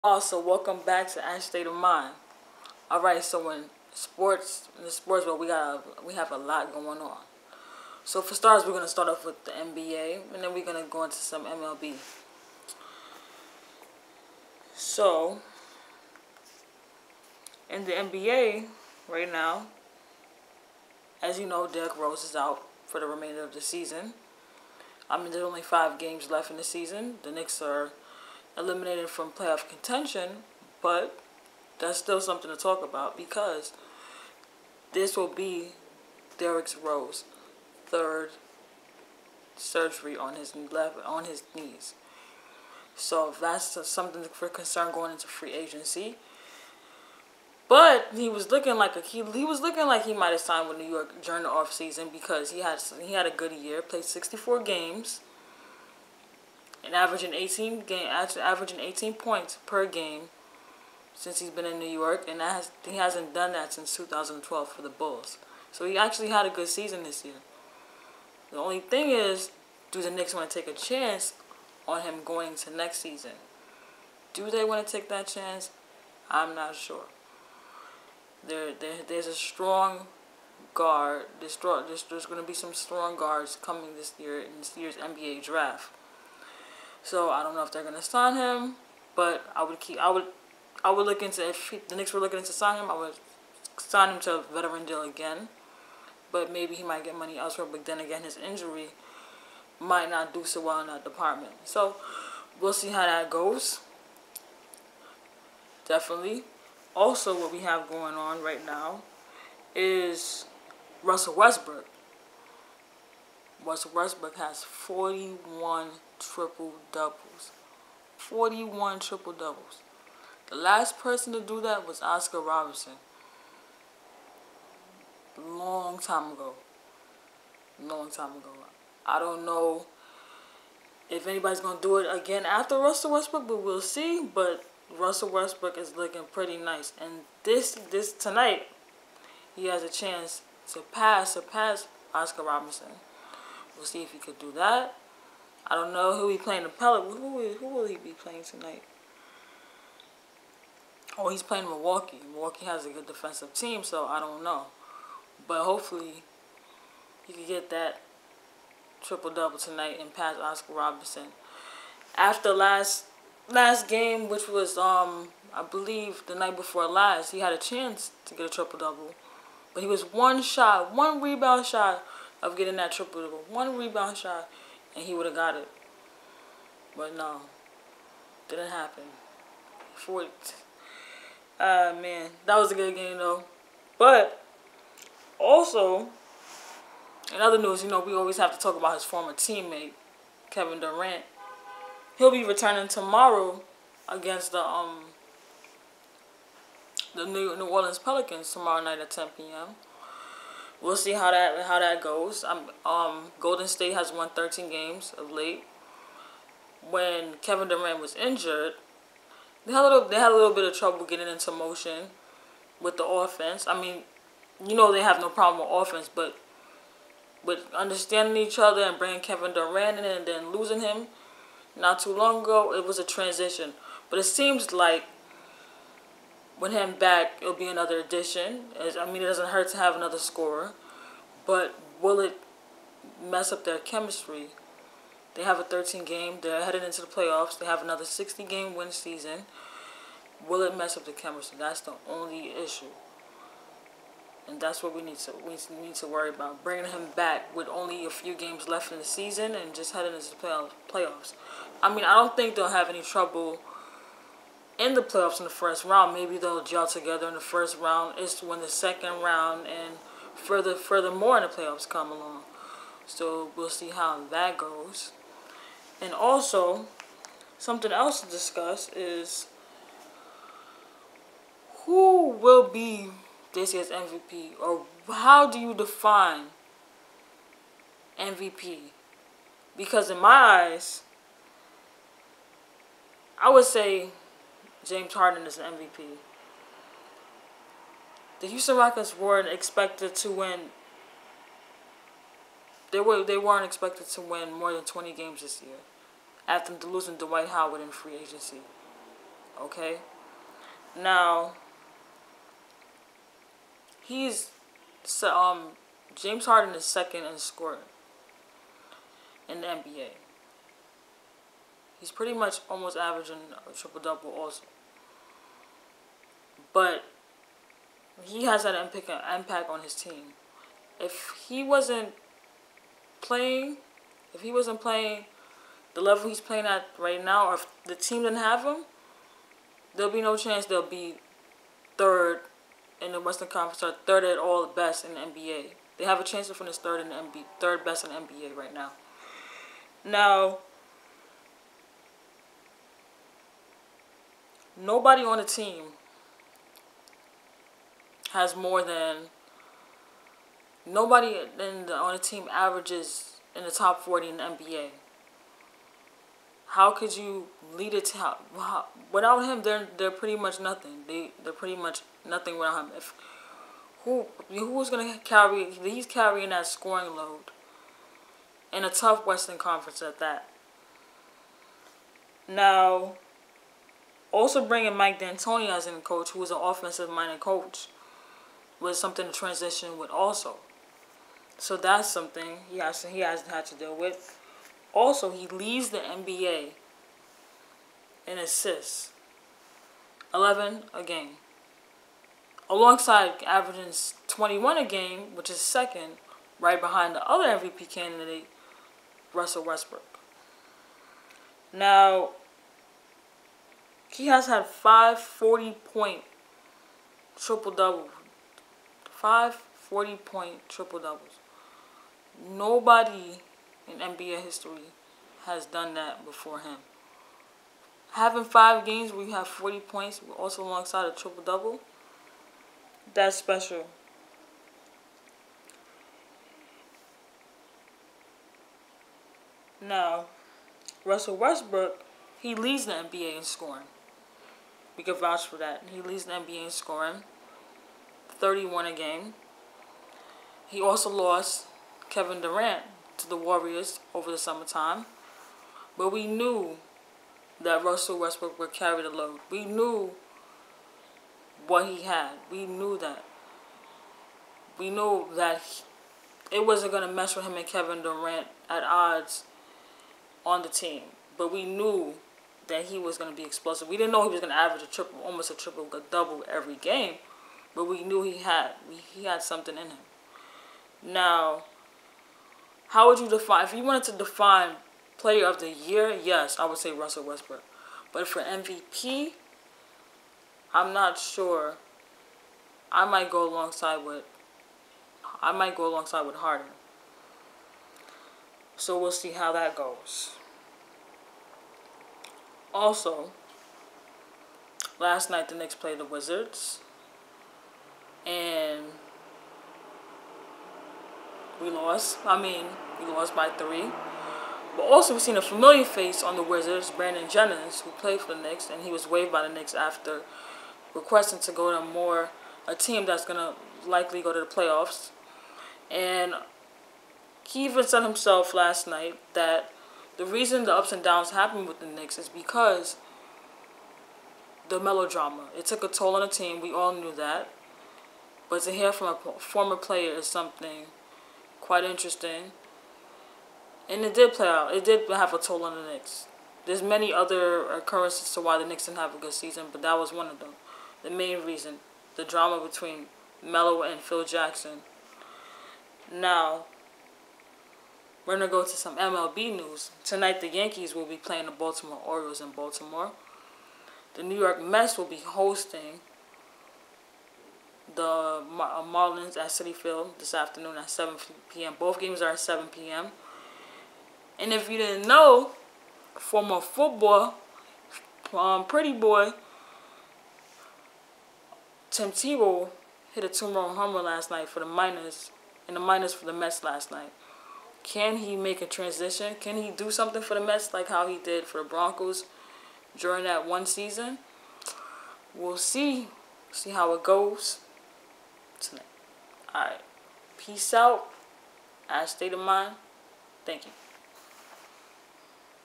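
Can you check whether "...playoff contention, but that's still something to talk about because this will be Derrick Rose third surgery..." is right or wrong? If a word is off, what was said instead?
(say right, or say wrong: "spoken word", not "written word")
right.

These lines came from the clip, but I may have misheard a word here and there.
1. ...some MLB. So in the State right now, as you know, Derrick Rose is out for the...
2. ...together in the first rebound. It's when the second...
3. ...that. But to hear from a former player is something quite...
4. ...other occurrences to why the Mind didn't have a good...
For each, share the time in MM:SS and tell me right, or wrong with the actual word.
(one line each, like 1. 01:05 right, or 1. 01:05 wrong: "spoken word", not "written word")
1. 00:11 wrong: "NBA", not "State"
2. 04:16 wrong: "round", not "rebound"
3. 08:47 right
4. 08:57 wrong: "Knicks", not "Mind".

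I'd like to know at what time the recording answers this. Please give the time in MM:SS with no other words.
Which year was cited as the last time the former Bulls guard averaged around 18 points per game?
01:03.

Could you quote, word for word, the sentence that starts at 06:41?
Now, he has had five 40 point triple doubles.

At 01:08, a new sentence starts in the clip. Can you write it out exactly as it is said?
The only thing is, do the Knicks want to take a chance on him going to next season?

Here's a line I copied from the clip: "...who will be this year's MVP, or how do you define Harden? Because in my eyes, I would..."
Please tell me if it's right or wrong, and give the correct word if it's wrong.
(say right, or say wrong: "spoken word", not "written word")
wrong: "MVP", not "Harden".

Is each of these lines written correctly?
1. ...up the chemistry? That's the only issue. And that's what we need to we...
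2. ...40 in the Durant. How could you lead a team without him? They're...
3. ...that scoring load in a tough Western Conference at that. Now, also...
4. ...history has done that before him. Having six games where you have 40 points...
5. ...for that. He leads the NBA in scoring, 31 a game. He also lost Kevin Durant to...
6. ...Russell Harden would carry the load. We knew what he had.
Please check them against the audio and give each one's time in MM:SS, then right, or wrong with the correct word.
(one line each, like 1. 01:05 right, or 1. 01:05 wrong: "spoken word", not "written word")
1. 04:00 right
2. 05:54 wrong: "NBA", not "Durant"
3. 06:06 right
4. 06:54 wrong: "five", not "six"
5. 07:15 right
6. 07:27 wrong: "Westbrook", not "Harden".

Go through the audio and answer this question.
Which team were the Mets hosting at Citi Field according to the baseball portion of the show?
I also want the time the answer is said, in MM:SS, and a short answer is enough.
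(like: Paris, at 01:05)
Marlins, at 09:18.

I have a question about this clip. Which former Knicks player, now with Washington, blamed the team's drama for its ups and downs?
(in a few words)
Brandon Jennings.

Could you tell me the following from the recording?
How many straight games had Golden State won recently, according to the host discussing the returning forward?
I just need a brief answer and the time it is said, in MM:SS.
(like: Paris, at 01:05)
13, at 03:24.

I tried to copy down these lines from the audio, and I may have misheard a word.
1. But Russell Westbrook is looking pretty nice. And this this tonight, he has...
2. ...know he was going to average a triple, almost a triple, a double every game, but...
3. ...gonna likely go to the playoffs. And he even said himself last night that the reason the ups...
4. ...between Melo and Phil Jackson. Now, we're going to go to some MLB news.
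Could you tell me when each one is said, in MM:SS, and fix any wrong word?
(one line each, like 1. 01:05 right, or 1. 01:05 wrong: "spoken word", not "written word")
1. 02:14 right
2. 07:44 right
3. 08:33 right
4. 09:02 right.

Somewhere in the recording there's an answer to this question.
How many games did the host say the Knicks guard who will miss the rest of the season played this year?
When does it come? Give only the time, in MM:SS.
00:54.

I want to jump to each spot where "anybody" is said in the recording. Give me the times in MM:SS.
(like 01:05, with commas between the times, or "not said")
02:11.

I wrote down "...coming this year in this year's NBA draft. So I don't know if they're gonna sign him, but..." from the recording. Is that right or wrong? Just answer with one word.
right.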